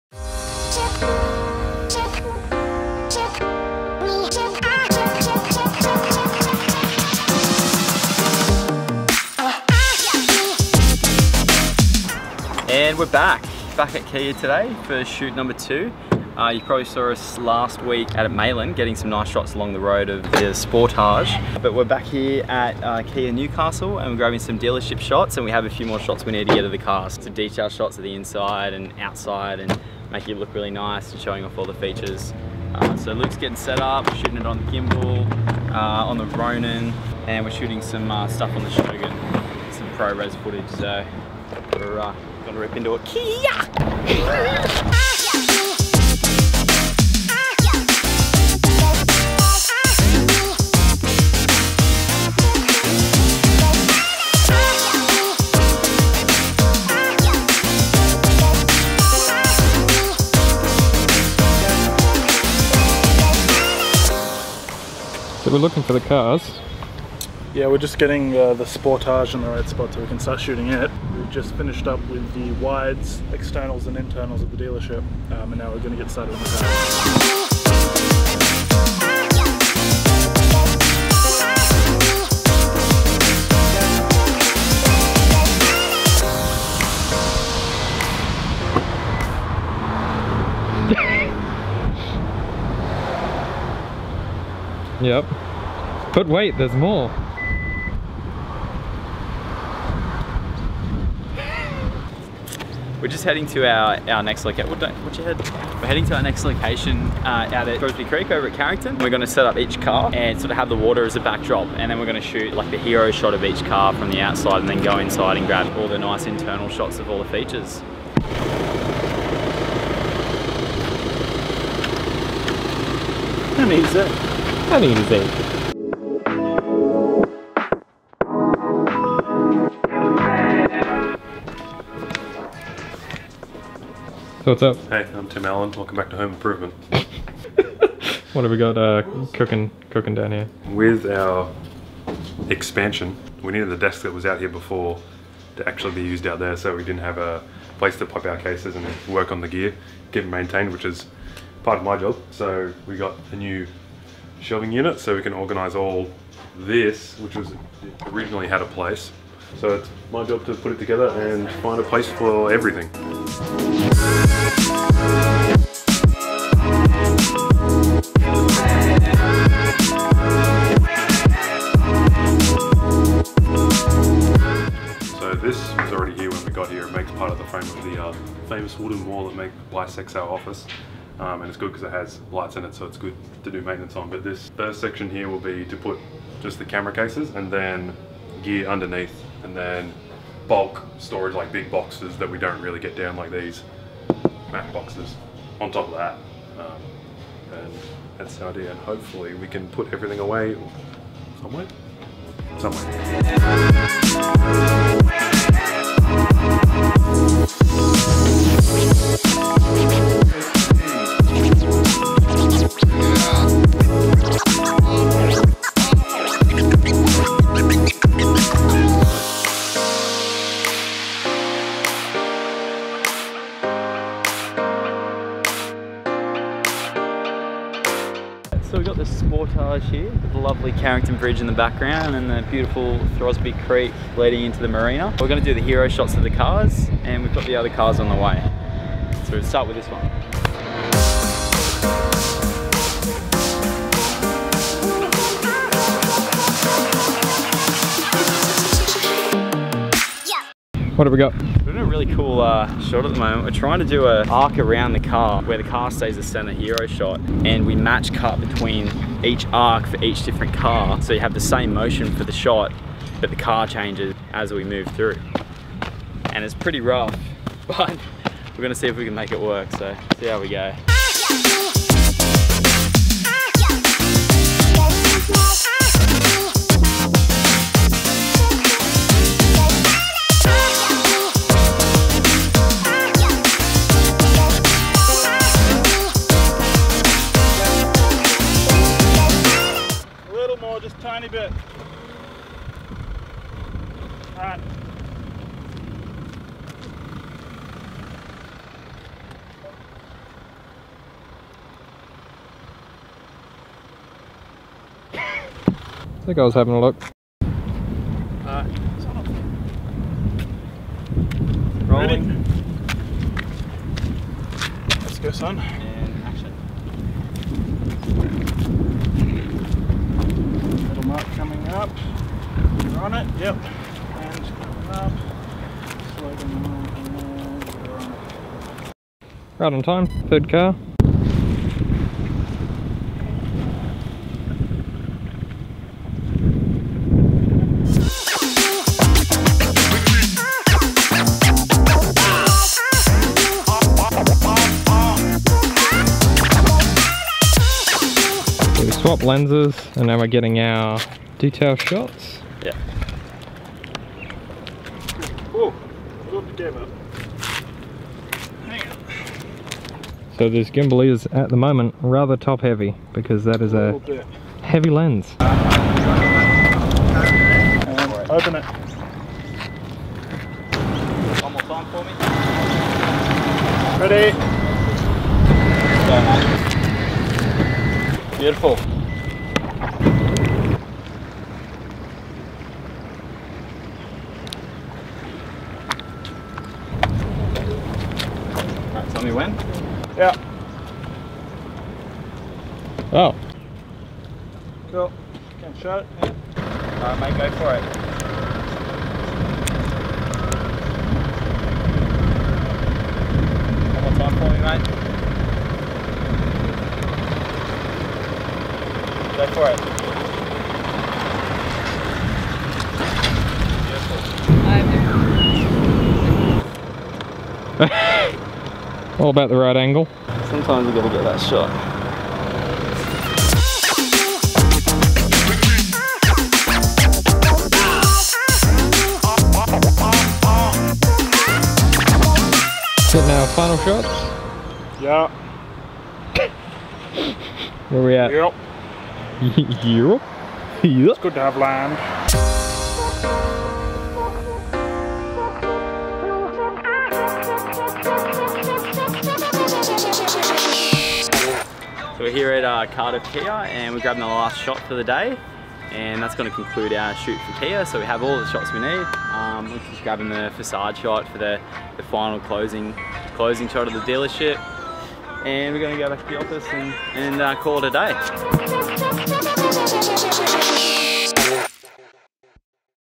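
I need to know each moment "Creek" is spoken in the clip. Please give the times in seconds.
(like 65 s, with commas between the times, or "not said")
108 s, 233 s.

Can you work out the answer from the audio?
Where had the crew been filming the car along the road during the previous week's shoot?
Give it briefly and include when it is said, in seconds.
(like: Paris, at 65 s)
Maitland, at 18 s.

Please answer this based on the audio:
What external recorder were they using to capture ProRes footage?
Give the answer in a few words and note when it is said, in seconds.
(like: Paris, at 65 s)
Shogun, at 38 s.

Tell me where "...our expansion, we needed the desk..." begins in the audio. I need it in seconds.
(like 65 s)
141 s.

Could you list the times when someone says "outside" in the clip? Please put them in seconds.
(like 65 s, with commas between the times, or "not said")
28 s, 114 s.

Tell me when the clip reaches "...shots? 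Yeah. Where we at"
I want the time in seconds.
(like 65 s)
433 s.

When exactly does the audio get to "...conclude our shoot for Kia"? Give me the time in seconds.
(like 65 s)
456 s.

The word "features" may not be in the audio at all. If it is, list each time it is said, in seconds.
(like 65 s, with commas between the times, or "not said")
31 s, 117 s.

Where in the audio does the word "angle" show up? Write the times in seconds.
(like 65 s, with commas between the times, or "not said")
419 s.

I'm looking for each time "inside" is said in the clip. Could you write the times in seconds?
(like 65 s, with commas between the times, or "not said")
28 s, 114 s.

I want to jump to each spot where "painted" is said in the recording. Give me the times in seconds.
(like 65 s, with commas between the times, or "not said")
not said.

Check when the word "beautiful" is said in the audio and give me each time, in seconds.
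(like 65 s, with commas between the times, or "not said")
232 s, 378 s, 417 s.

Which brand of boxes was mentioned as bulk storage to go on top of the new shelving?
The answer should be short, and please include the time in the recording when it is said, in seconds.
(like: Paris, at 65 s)
Mac, at 194 s.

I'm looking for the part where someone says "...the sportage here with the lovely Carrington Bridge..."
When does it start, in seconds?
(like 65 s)
229 s.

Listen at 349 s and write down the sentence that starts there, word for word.
lenses and now we're getting our detail shots.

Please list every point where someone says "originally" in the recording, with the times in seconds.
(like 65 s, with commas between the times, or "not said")
158 s.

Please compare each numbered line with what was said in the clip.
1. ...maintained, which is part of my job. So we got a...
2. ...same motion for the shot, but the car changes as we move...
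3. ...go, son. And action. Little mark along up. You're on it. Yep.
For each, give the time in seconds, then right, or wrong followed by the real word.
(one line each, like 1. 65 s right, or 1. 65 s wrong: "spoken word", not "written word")
1. 150 s right
2. 261 s right
3. 315 s wrong: "coming", not "along".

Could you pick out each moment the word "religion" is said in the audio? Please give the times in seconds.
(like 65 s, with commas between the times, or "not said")
not said.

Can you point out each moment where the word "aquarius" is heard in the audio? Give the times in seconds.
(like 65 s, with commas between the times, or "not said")
not said.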